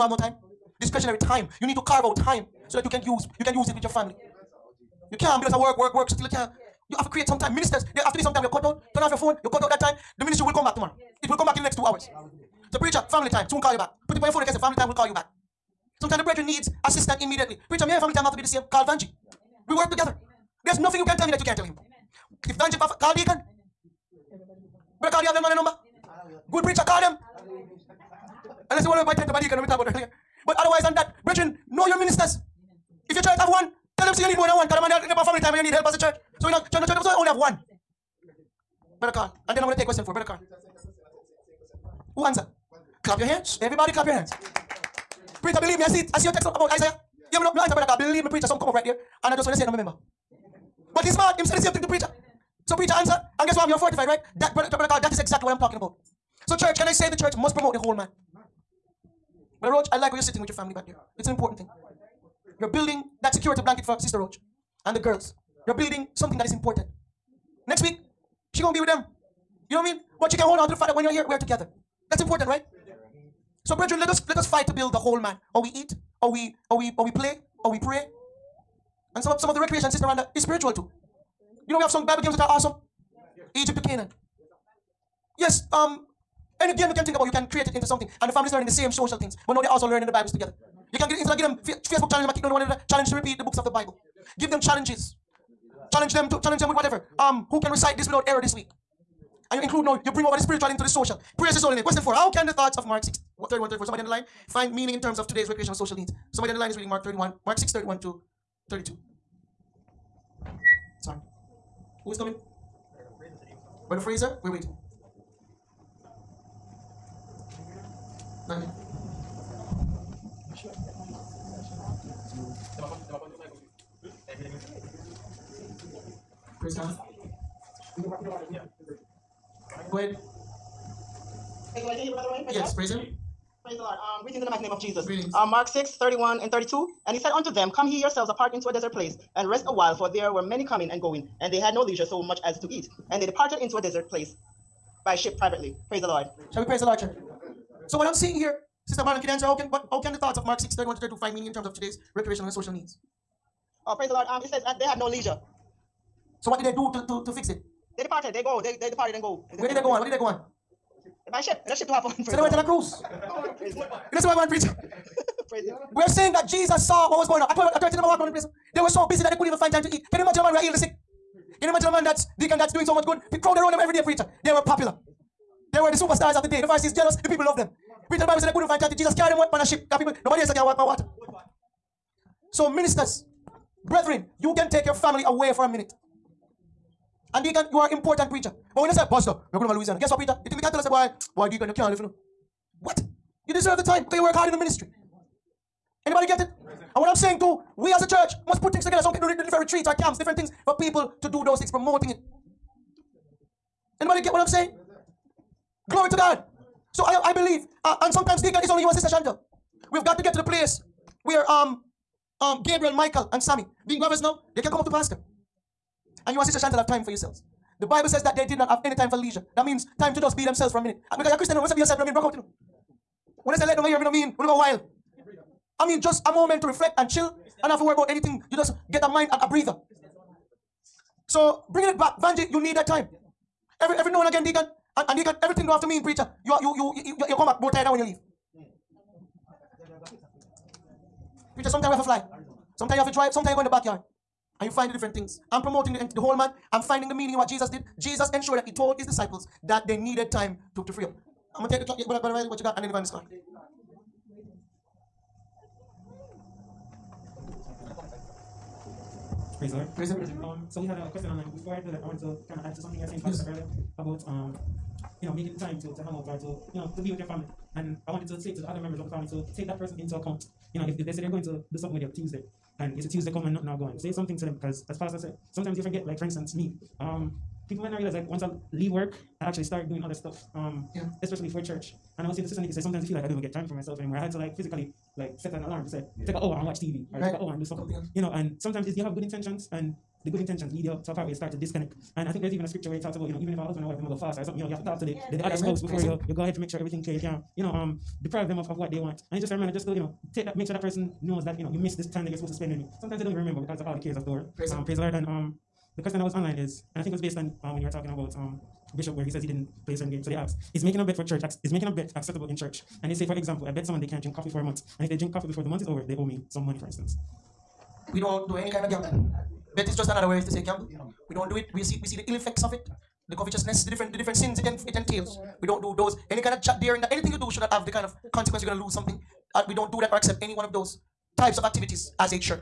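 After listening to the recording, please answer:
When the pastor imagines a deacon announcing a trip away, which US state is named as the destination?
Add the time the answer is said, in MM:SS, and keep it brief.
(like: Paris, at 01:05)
Louisiana, at 03:09.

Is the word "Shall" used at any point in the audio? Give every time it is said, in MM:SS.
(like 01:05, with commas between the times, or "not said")
02:26.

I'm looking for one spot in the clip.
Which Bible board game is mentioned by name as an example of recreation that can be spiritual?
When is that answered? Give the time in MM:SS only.
01:23.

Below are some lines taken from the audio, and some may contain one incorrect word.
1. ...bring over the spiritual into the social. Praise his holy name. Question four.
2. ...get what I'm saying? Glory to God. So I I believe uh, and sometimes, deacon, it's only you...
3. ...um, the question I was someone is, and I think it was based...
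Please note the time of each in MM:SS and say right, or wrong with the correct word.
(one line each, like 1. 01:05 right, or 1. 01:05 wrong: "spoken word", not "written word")
1. 01:40 right
2. 03:24 right
3. 05:05 wrong: "online", not "someone".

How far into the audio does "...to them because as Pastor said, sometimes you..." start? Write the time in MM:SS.
04:34.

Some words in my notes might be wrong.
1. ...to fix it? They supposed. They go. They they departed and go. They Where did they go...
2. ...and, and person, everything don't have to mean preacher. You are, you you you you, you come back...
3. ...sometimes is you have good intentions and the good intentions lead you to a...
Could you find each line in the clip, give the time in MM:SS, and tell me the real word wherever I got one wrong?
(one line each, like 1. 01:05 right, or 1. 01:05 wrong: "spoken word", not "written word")
1. 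02:37 wrong: "departed", not "supposed"
2. 03:54 wrong: "deacon", not "person"
3. 04:48 right.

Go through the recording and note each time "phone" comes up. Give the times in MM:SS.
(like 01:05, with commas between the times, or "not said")
00:09, 00:14.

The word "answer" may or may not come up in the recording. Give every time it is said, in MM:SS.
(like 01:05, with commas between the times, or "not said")
00:42, 00:47, 00:52, 02:29.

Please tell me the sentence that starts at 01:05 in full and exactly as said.
You're building something that is important.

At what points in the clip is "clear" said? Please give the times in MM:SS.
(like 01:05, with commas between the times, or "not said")
04:57.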